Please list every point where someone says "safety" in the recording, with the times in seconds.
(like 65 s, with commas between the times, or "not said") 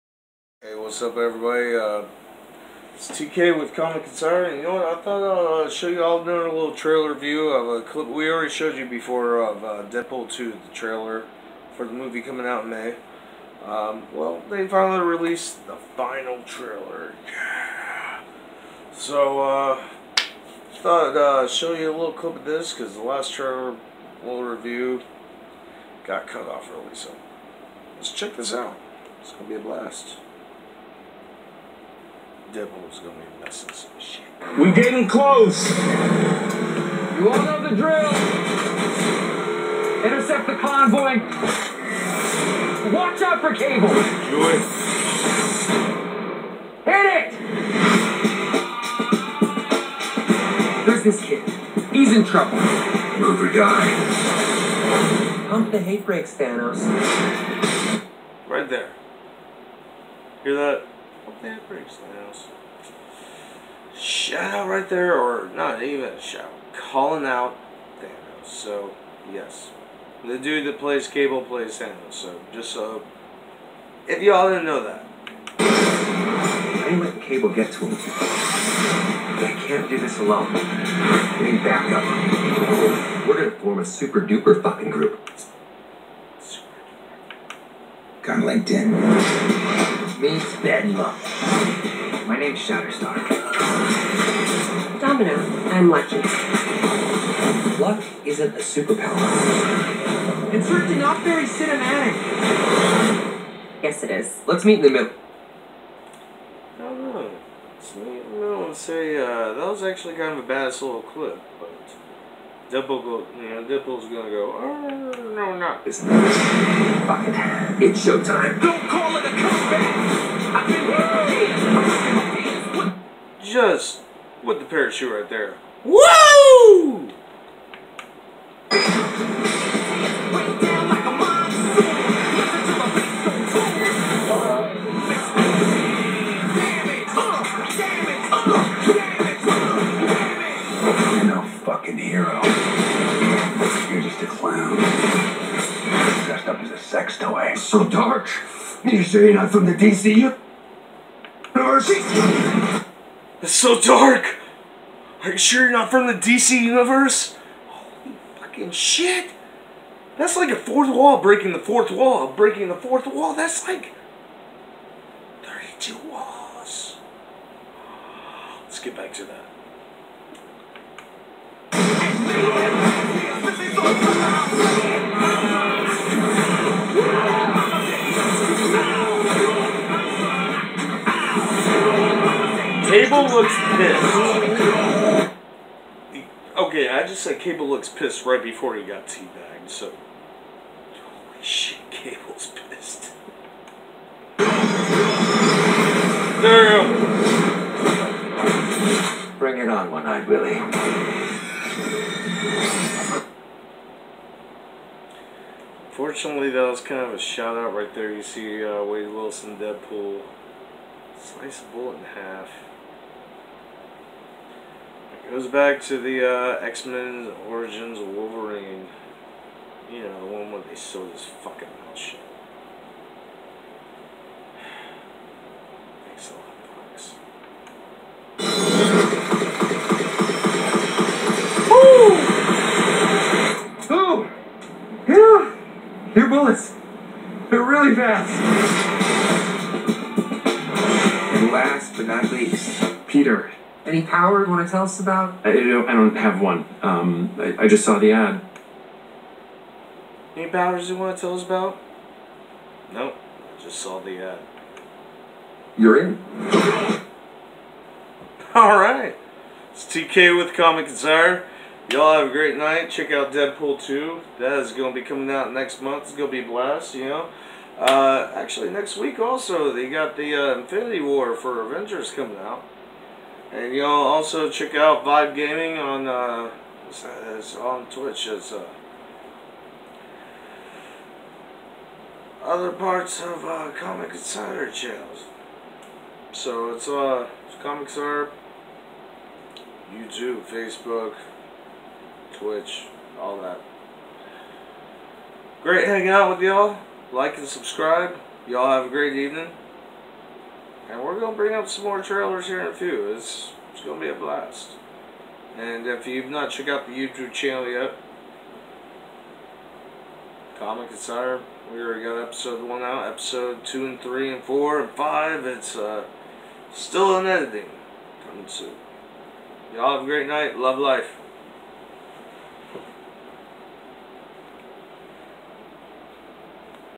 not said.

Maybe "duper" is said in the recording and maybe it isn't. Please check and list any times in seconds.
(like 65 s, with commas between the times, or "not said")
84 s.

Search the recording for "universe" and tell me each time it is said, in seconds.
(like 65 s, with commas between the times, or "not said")
150 s, 156 s.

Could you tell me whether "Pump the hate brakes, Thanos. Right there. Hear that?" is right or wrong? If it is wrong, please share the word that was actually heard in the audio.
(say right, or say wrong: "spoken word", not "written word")
right.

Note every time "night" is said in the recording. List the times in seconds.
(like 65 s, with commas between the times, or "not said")
262 s, 320 s.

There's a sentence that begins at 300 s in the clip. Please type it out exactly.
And we're going to bring up some more trailers here in a few.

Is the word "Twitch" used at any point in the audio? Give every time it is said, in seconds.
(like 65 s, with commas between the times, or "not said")
277 s, 292 s.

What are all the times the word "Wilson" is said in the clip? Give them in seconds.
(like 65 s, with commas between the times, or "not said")
209 s.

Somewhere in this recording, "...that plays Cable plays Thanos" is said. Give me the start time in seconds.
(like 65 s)
70 s.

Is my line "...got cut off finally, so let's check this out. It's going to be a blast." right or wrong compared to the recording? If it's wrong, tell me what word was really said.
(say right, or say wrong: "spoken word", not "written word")
wrong: "early", not "finally".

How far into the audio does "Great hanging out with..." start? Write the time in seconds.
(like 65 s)
295 s.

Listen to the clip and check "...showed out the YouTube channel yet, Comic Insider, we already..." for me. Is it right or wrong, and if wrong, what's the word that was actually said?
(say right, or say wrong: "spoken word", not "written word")
wrong: "checked", not "showed".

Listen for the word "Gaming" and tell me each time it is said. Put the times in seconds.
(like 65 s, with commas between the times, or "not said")
275 s.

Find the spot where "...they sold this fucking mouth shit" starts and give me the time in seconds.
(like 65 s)
220 s.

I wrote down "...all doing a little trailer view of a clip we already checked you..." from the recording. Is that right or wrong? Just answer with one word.
wrong.